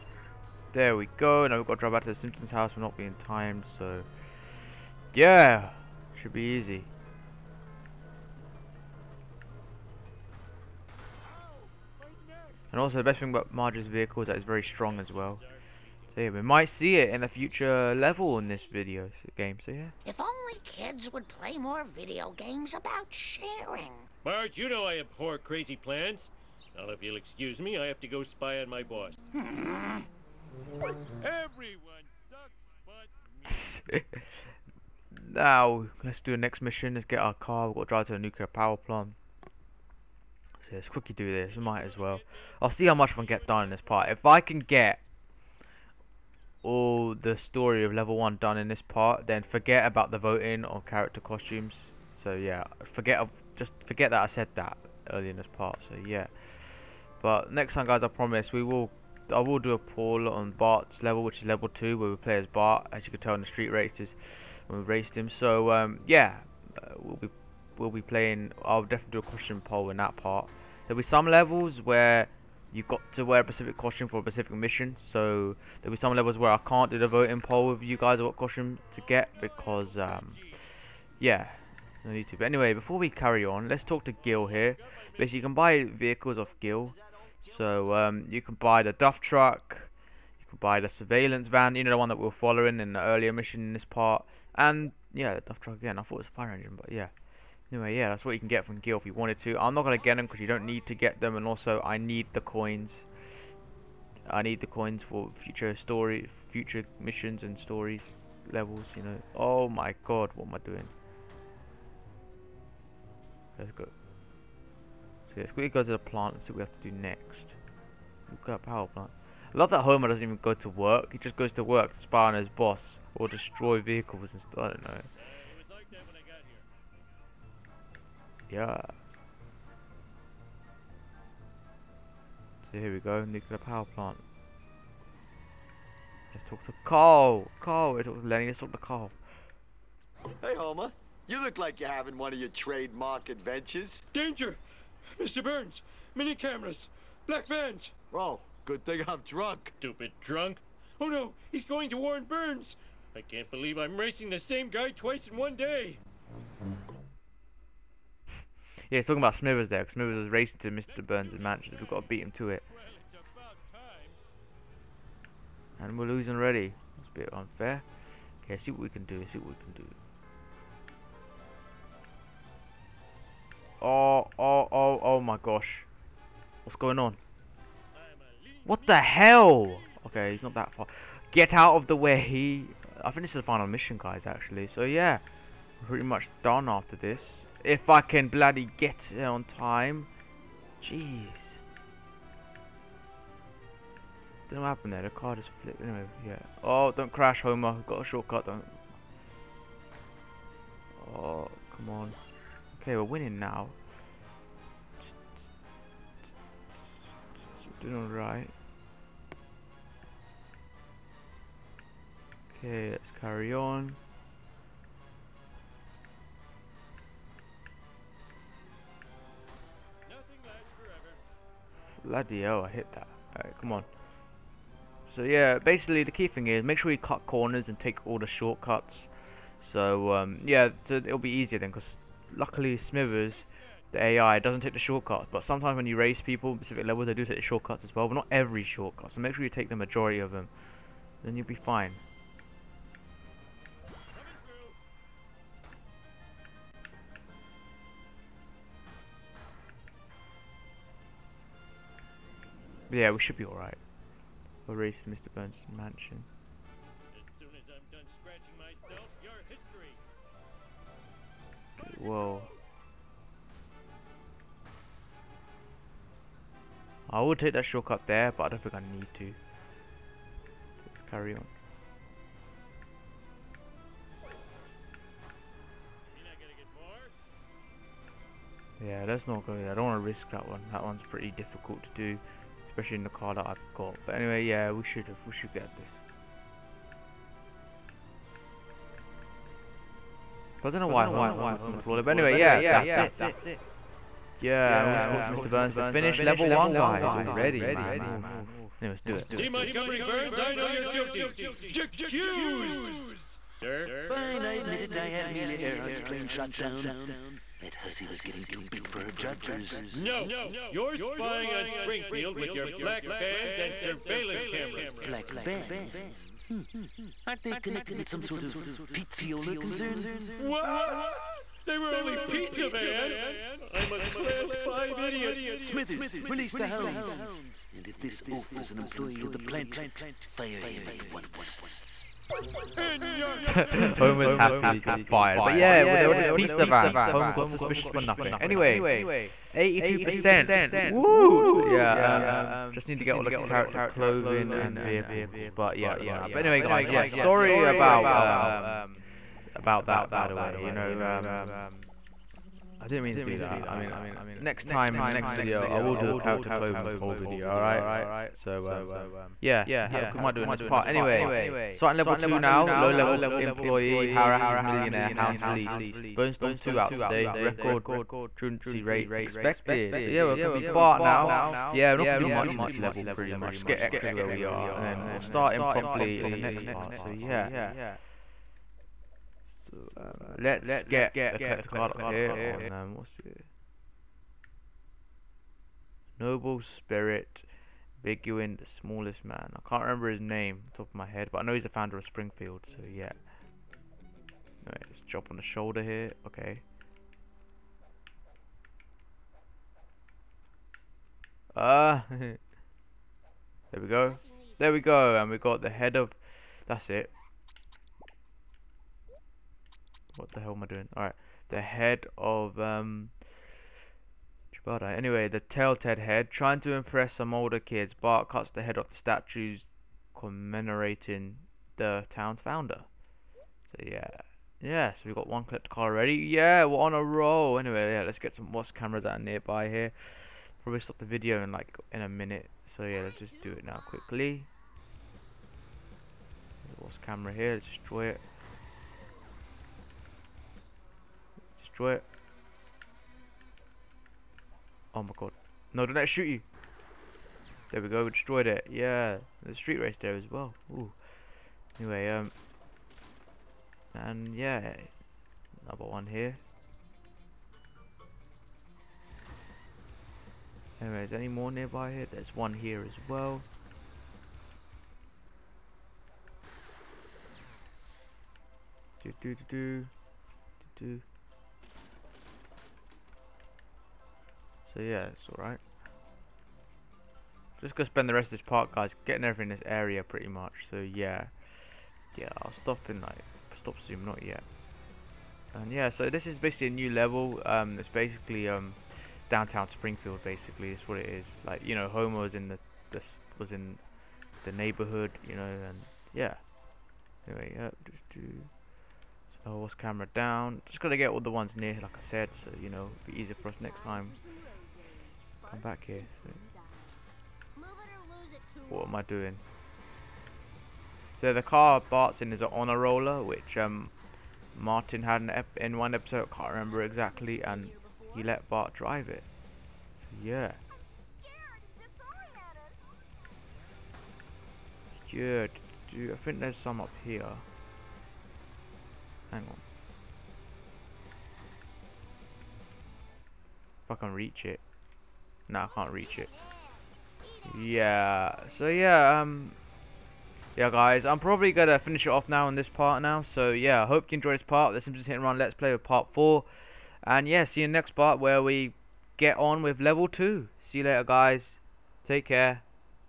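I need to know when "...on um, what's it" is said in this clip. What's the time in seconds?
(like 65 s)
382 s.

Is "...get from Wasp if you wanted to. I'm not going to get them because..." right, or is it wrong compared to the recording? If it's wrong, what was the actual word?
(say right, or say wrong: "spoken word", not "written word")
wrong: "Gil", not "Wasp".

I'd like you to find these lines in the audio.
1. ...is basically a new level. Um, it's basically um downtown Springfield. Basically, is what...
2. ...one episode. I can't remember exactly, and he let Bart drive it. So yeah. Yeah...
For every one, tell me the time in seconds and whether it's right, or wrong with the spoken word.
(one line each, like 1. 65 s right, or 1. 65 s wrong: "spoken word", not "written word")
1. 486 s right
2. 515 s right.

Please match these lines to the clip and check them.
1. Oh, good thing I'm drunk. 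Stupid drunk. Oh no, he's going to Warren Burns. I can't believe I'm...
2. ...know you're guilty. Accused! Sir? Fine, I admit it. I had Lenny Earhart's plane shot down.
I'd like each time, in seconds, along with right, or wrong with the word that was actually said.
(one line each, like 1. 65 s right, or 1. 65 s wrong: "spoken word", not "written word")
1. 148 s right
2. 300 s wrong: "Amelia", not "Lenny".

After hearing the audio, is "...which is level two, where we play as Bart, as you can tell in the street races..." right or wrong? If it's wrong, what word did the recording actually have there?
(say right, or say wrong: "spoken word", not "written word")
right.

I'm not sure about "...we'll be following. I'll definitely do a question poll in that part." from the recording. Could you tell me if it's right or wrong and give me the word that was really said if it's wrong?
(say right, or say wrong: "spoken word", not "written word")
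wrong: "playing", not "following".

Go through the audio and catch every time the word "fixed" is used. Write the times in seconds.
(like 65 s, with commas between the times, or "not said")
not said.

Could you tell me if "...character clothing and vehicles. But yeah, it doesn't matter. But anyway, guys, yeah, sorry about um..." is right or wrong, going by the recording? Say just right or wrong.
right.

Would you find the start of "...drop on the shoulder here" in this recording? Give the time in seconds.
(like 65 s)
395 s.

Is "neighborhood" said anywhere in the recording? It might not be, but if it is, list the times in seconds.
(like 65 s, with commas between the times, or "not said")
494 s.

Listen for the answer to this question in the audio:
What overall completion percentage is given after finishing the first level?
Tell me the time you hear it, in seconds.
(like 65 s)
339 s.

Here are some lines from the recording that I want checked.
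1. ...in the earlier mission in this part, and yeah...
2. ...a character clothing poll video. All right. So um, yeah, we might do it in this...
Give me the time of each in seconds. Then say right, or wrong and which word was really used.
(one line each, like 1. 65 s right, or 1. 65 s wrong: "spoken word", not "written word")
1. 92 s right
2. 356 s right.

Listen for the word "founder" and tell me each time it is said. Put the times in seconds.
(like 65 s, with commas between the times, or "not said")
391 s, 422 s.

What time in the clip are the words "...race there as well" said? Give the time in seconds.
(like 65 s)
449 s.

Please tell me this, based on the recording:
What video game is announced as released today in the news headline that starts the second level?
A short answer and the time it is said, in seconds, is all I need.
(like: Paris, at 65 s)
Bone Storm 2, at 366 s.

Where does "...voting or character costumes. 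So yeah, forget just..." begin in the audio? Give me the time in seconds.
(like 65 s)
50 s.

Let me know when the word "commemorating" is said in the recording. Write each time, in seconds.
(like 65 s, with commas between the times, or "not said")
420 s.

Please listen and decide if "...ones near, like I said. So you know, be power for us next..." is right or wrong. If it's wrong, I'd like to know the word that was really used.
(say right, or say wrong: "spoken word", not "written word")
wrong: "easier", not "power".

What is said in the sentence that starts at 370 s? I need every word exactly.
So yeah, we're gonna be Bart now.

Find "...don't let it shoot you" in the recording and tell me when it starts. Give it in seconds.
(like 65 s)
445 s.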